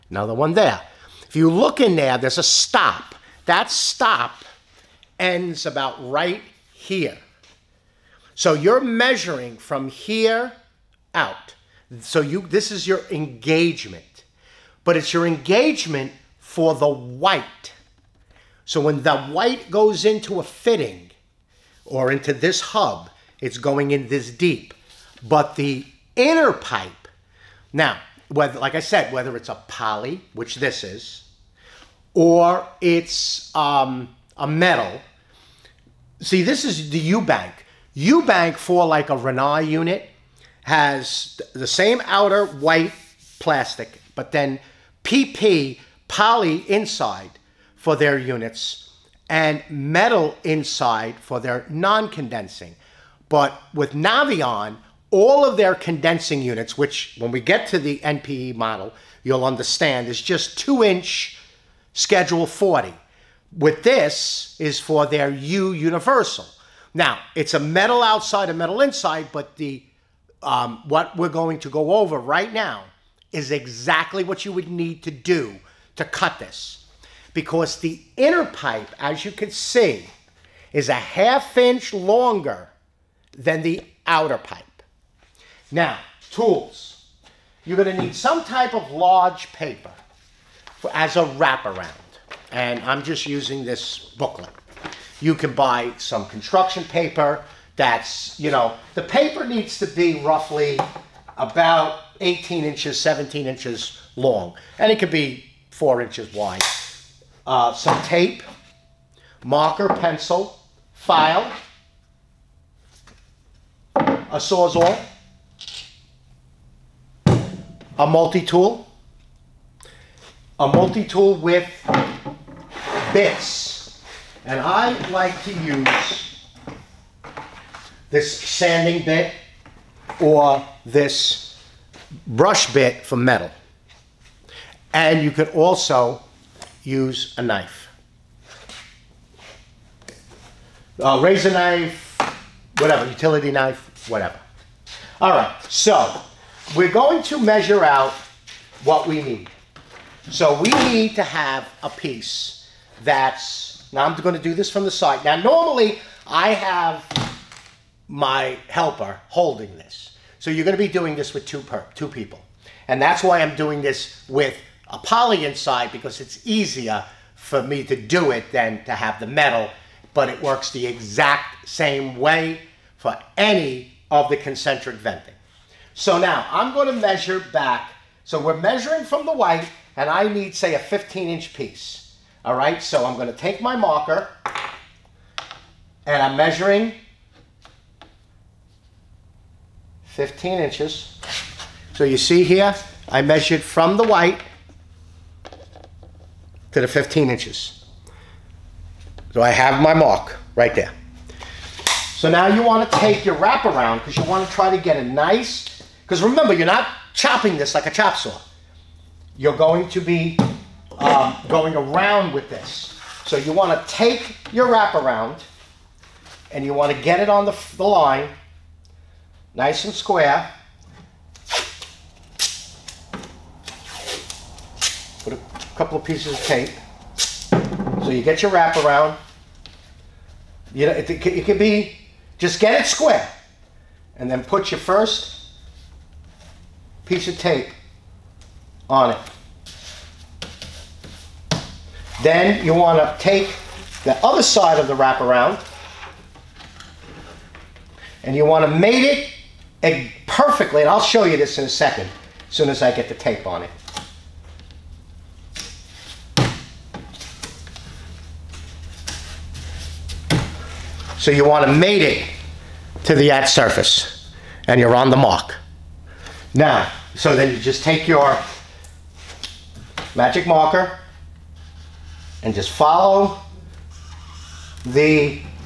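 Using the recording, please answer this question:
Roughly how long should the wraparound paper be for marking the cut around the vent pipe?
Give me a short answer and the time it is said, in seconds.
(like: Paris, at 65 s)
18 inches, at 102 s.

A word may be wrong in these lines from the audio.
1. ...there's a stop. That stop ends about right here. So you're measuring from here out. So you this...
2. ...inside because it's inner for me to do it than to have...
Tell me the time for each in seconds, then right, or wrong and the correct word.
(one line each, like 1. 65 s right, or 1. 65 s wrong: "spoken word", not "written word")
1. 2 s right
2. 165 s wrong: "easier", not "inner".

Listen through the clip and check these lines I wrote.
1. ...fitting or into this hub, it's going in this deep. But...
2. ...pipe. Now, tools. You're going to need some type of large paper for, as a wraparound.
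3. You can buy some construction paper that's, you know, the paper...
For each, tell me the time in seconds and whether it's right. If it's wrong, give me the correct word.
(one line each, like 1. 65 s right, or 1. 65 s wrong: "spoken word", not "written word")
1. 20 s right
2. 84 s right
3. 95 s right.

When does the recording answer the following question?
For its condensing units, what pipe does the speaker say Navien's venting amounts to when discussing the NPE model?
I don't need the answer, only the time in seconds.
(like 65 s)
60 s.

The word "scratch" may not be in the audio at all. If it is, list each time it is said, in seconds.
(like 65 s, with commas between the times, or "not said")
not said.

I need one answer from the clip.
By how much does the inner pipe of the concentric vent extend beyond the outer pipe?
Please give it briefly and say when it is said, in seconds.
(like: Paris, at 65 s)
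half inch, at 80 s.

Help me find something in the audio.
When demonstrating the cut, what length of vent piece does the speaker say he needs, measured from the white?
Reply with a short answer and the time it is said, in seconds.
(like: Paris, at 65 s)
15 inch, at 180 s.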